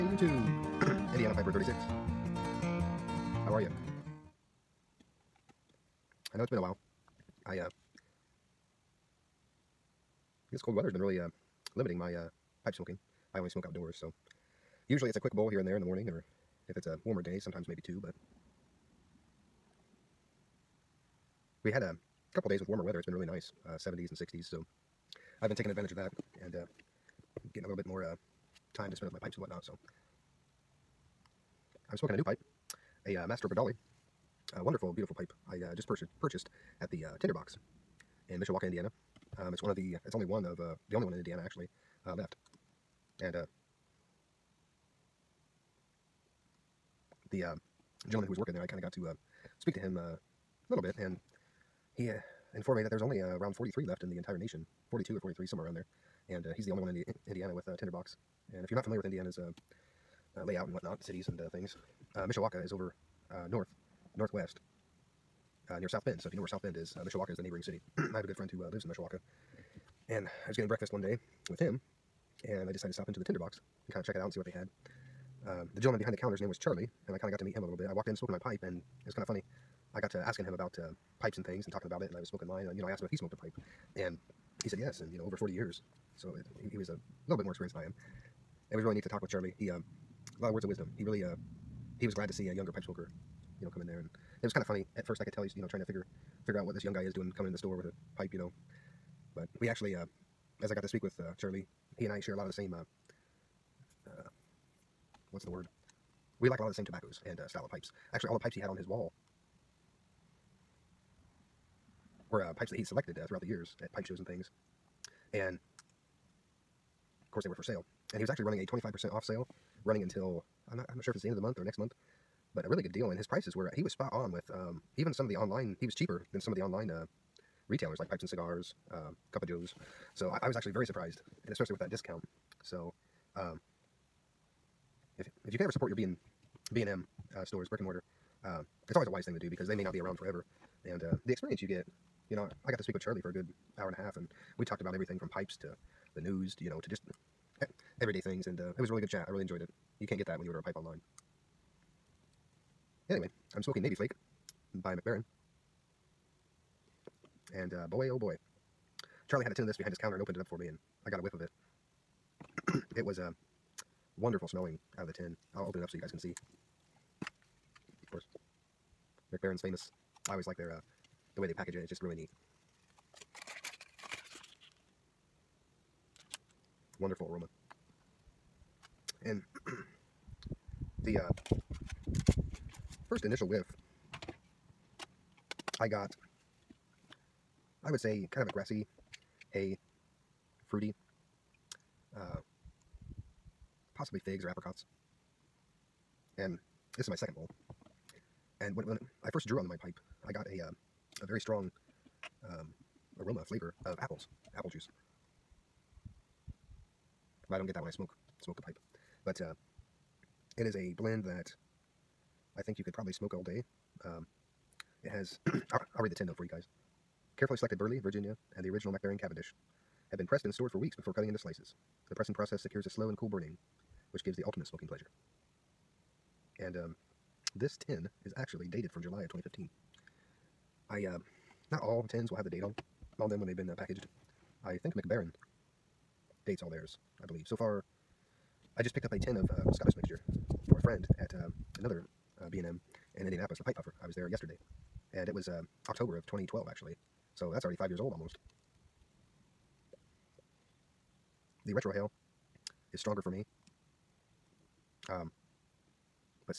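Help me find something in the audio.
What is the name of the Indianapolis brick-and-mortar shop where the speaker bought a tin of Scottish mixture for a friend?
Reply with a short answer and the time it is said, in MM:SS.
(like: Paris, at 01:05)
The Pipe Puffer, at 04:03.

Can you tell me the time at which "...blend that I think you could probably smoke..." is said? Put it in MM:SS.
03:30.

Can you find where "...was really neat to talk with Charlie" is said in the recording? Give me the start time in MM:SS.
01:28.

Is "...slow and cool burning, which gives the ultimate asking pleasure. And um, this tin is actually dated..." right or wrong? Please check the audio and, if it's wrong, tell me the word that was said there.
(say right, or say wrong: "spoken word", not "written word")
wrong: "smoking", not "asking".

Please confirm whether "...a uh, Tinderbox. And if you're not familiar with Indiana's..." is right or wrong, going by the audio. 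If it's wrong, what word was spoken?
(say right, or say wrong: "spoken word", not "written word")
right.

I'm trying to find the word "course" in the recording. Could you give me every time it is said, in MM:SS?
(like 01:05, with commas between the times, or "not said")
01:57, 02:48.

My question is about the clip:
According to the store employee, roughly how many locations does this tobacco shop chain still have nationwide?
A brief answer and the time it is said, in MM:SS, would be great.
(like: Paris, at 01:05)
43, at 00:53.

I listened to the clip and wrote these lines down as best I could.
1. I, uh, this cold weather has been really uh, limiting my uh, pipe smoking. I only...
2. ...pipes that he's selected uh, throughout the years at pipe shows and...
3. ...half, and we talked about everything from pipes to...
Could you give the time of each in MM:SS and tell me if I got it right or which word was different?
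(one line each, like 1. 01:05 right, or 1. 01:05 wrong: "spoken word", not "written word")
1. 00:07 right
2. 01:52 right
3. 02:23 right.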